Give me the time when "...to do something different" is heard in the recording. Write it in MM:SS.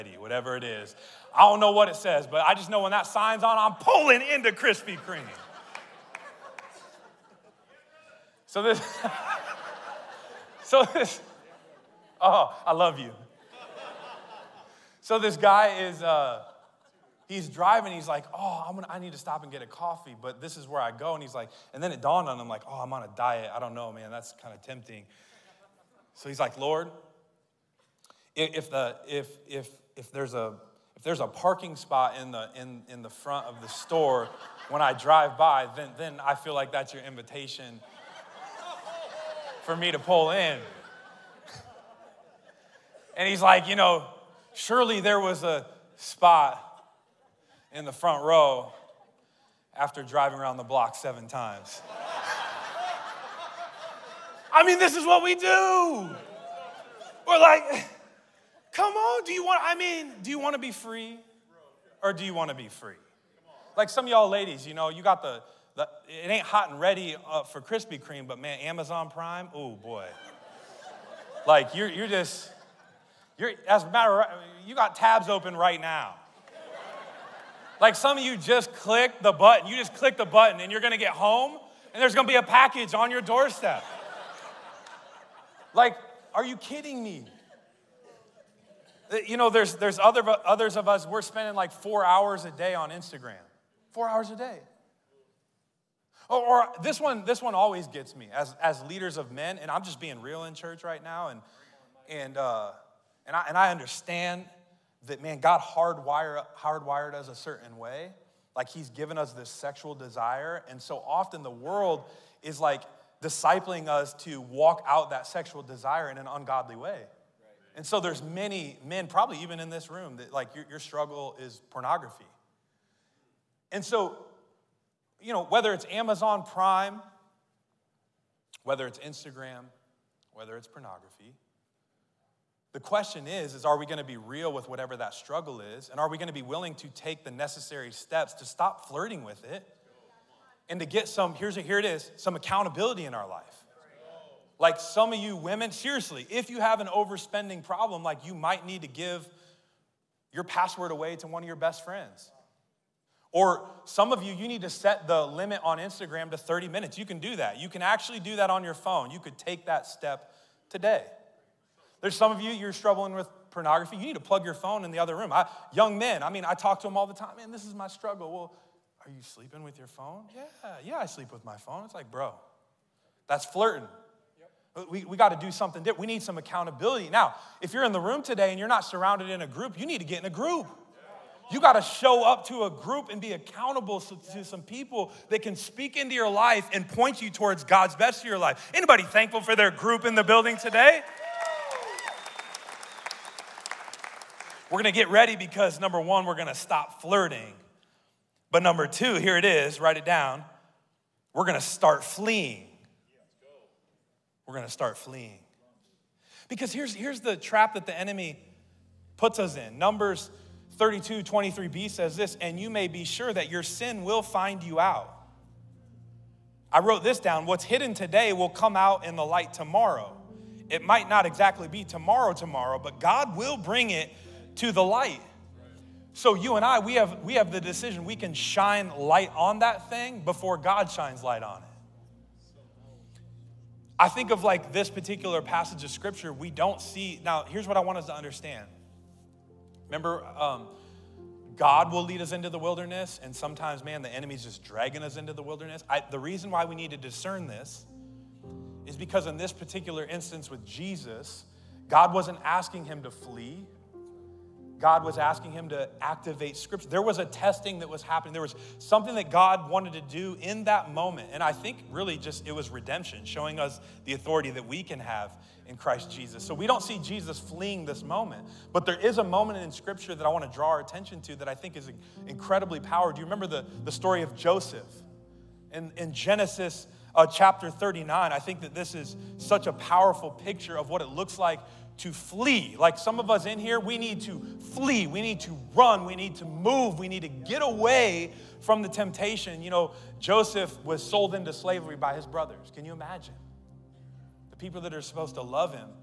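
02:55.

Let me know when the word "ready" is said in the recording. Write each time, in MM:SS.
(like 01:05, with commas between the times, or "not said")
01:06, 03:15.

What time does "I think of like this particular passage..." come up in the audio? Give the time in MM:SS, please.
03:53.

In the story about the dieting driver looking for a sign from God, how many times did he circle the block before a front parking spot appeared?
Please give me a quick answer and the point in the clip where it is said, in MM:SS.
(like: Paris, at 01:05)
7, at 00:50.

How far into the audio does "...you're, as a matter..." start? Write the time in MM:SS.
01:13.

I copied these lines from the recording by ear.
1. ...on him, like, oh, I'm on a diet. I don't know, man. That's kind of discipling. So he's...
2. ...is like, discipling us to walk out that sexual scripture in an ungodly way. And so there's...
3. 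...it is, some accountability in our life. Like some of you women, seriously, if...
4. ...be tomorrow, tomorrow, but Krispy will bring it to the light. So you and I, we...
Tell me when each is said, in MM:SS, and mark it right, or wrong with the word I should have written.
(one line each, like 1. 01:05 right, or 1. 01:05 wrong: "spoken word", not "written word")
1. 00:22 wrong: "tempting", not "discipling"
2. 01:52 wrong: "desire", not "scripture"
3. 02:21 right
4. 03:41 wrong: "God", not "Krispy".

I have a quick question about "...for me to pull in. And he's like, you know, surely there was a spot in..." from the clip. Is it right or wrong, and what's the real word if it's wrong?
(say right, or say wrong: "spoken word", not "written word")
right.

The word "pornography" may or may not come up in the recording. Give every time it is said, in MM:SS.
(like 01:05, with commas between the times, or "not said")
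02:01, 02:10, 02:43.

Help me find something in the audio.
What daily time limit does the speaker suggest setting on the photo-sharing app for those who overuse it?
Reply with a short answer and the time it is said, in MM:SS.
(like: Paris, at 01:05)
30 minutes, at 02:36.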